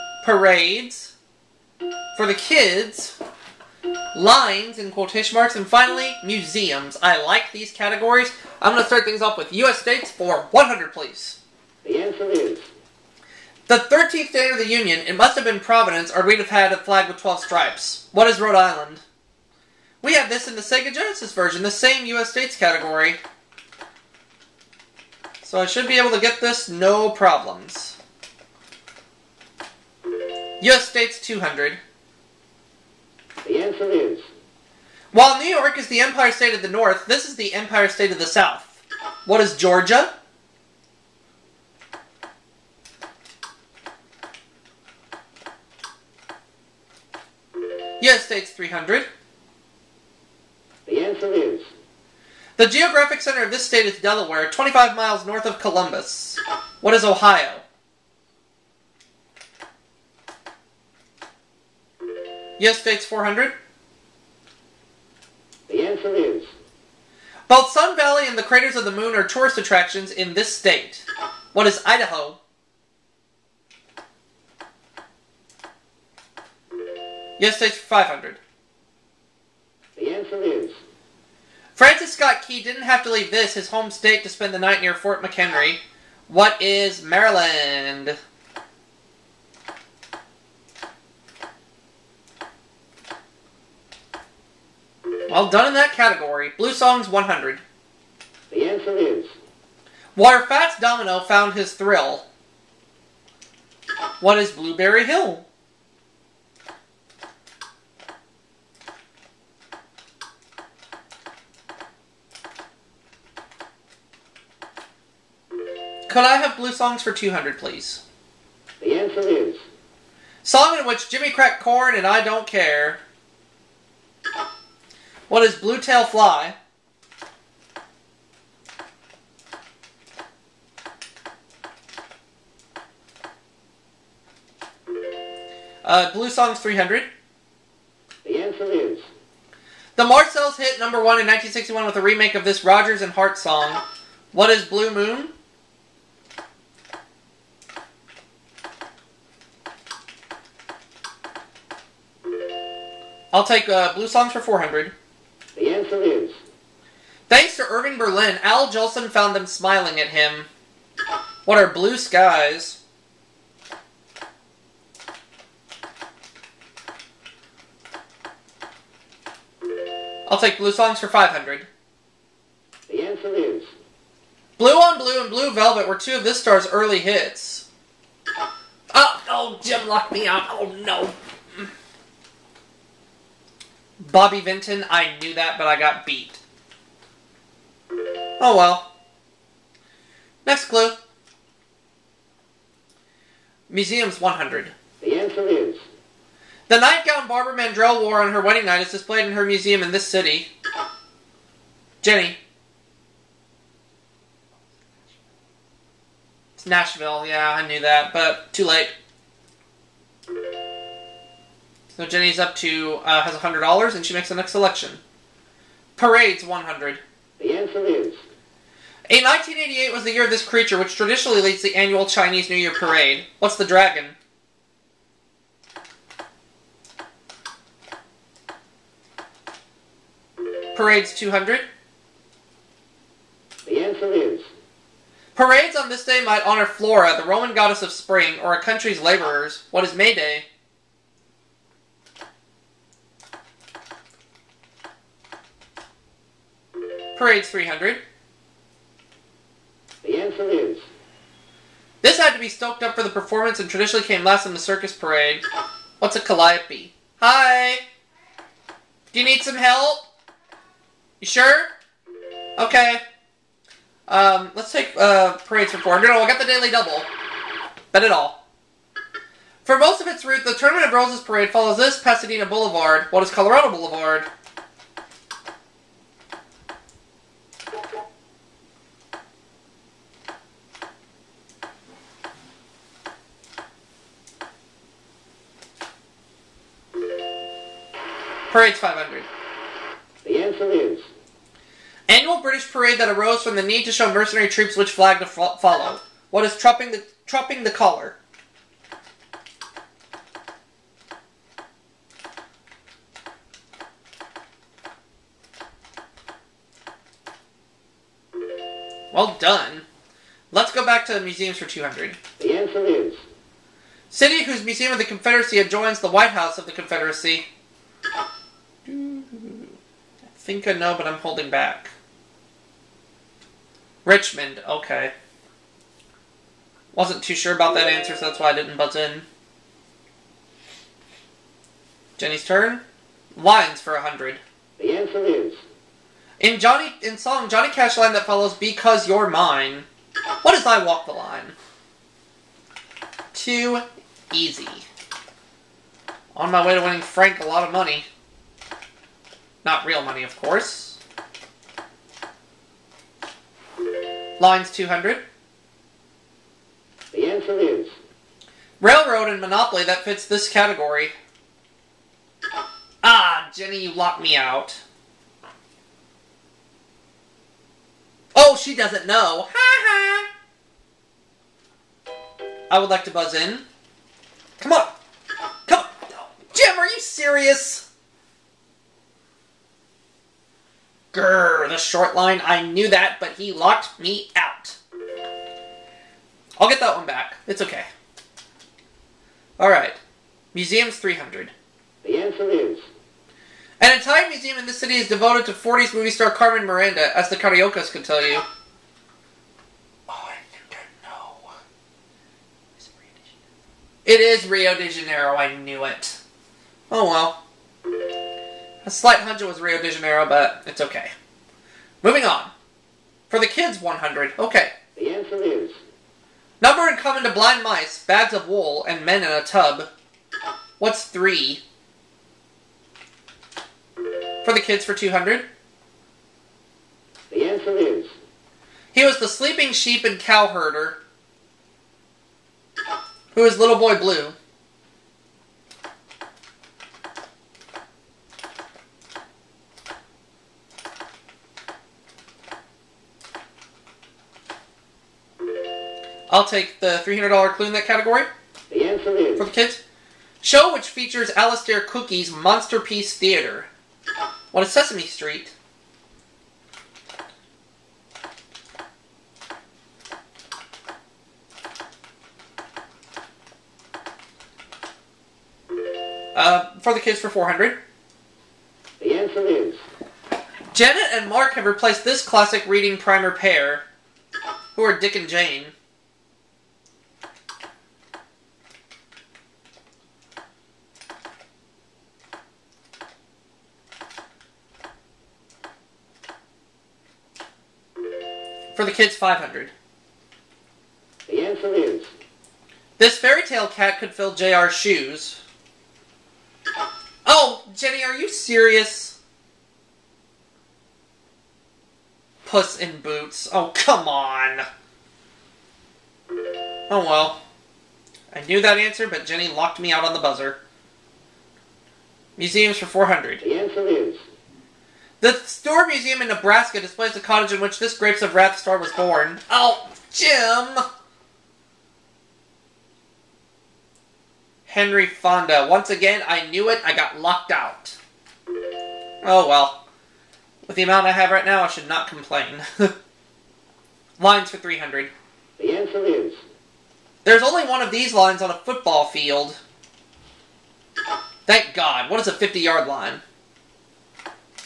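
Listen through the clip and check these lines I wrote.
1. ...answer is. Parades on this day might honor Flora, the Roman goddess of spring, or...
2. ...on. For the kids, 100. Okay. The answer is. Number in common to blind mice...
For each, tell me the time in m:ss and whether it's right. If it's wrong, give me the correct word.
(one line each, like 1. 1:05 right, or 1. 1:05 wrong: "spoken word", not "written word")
1. 3:53 right
2. 6:52 right.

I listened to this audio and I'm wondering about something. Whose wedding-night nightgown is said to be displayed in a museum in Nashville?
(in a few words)
Barbara Mandrell.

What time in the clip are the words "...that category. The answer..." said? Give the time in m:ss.
7:27.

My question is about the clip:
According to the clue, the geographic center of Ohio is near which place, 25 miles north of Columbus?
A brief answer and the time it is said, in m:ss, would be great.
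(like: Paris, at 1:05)
Delaware, at 0:54.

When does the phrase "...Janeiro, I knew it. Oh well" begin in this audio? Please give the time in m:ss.
6:44.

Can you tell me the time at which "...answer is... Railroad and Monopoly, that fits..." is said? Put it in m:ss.
5:57.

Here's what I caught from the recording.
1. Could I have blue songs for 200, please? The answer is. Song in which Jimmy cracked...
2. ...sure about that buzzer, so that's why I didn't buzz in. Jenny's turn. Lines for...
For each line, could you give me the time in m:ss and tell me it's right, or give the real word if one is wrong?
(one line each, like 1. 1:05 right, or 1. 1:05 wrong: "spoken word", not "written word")
1. 1:56 right
2. 5:27 wrong: "answer", not "buzzer".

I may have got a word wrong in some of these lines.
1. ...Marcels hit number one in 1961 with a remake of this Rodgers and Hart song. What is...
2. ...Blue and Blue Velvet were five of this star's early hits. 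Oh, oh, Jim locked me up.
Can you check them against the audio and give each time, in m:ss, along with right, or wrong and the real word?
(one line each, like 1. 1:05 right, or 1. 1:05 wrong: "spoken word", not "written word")
1. 2:20 right
2. 2:54 wrong: "two", not "five".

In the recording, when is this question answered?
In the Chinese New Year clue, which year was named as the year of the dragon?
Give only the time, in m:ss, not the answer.
3:39.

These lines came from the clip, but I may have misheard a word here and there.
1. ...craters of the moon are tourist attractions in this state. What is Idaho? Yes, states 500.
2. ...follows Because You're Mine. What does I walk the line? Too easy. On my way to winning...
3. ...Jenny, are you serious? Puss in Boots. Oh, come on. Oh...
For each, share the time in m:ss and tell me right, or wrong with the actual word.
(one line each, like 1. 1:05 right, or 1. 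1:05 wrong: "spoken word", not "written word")
1. 1:08 right
2. 5:38 right
3. 8:17 right.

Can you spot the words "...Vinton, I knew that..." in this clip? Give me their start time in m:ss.
3:04.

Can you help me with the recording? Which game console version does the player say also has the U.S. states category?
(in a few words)
Sega Genesis.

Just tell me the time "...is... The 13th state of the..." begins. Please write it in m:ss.
0:12.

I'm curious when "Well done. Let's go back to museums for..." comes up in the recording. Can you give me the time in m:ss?
5:09.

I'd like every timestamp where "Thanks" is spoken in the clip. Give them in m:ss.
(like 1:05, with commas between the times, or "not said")
2:37, 9:01.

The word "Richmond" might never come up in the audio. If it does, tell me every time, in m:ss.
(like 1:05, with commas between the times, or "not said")
5:24.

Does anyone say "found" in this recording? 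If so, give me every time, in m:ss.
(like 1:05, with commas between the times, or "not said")
1:41, 2:39.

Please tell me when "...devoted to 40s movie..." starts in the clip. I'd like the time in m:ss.
6:35.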